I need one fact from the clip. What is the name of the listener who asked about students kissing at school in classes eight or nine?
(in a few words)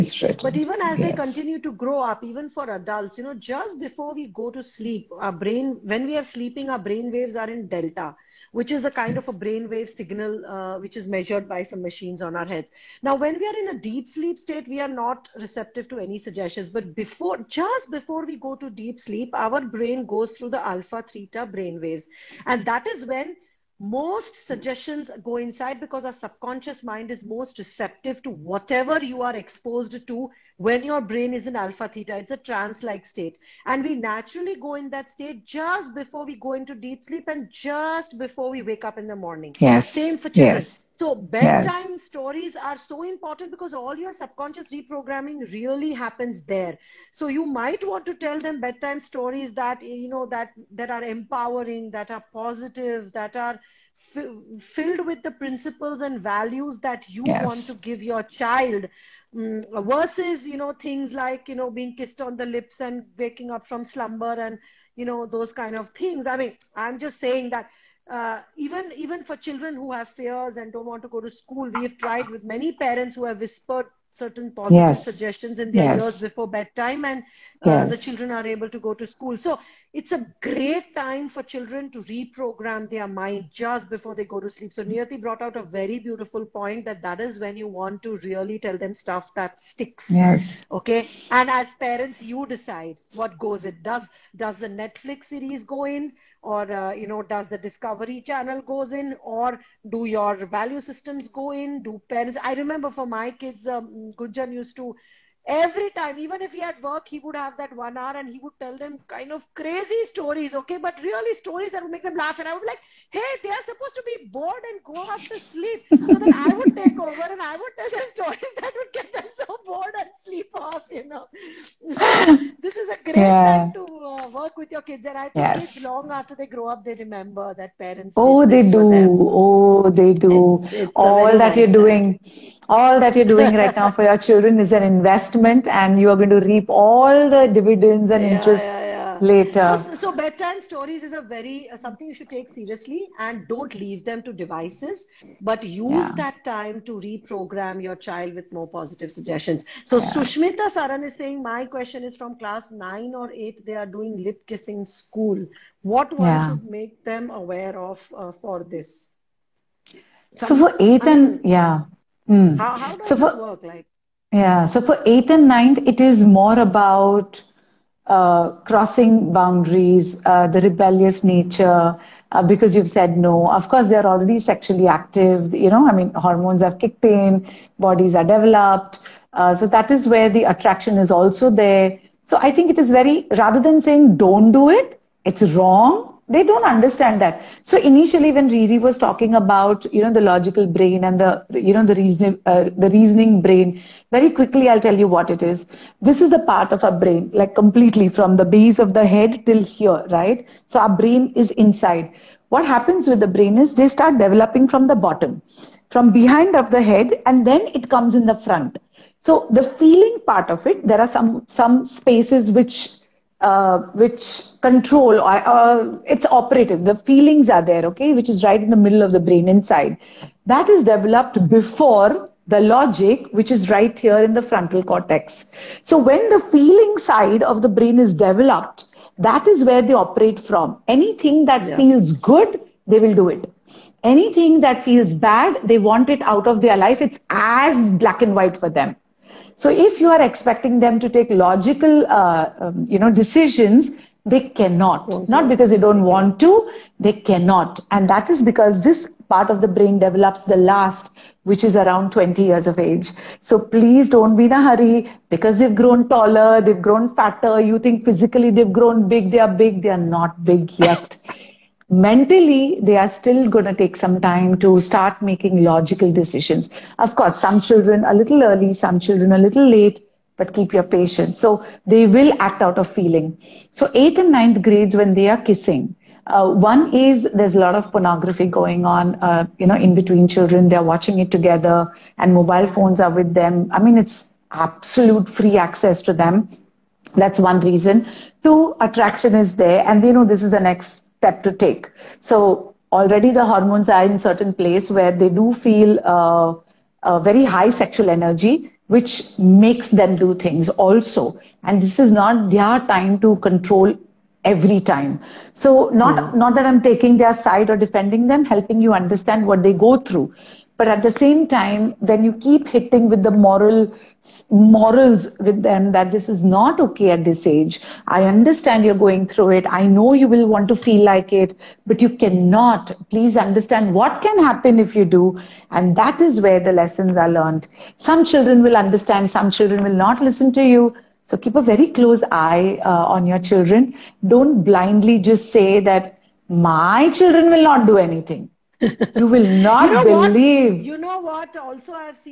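Sushmita Saran.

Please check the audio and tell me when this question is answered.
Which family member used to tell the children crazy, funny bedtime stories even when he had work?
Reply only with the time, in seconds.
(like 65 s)
104 s.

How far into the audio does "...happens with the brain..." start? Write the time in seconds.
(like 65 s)
202 s.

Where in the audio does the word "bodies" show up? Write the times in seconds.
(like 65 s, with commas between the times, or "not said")
177 s.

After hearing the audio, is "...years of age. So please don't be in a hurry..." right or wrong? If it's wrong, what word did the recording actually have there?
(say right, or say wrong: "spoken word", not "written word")
right.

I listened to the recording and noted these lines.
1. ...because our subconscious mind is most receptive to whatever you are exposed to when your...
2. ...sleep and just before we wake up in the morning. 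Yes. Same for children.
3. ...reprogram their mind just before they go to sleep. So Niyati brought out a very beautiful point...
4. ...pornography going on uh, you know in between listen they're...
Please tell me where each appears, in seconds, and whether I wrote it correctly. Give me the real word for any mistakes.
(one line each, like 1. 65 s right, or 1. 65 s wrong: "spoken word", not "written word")
1. 25 s right
2. 37 s right
3. 82 s right
4. 277 s wrong: "children", not "listen".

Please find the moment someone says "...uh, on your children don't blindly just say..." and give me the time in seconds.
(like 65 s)
332 s.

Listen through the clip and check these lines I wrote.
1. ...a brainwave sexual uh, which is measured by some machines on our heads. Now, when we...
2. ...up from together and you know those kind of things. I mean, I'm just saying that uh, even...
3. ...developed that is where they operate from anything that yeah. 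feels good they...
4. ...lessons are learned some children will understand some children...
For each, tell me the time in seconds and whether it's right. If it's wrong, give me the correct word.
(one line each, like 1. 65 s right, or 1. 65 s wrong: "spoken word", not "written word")
1. 9 s wrong: "signal", not "sexual"
2. 63 s wrong: "slumber", not "together"
3. 228 s right
4. 326 s right.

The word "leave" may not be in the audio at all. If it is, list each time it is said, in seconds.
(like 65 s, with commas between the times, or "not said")
143 s.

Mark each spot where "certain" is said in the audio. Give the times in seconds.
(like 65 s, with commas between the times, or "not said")
74 s, 294 s.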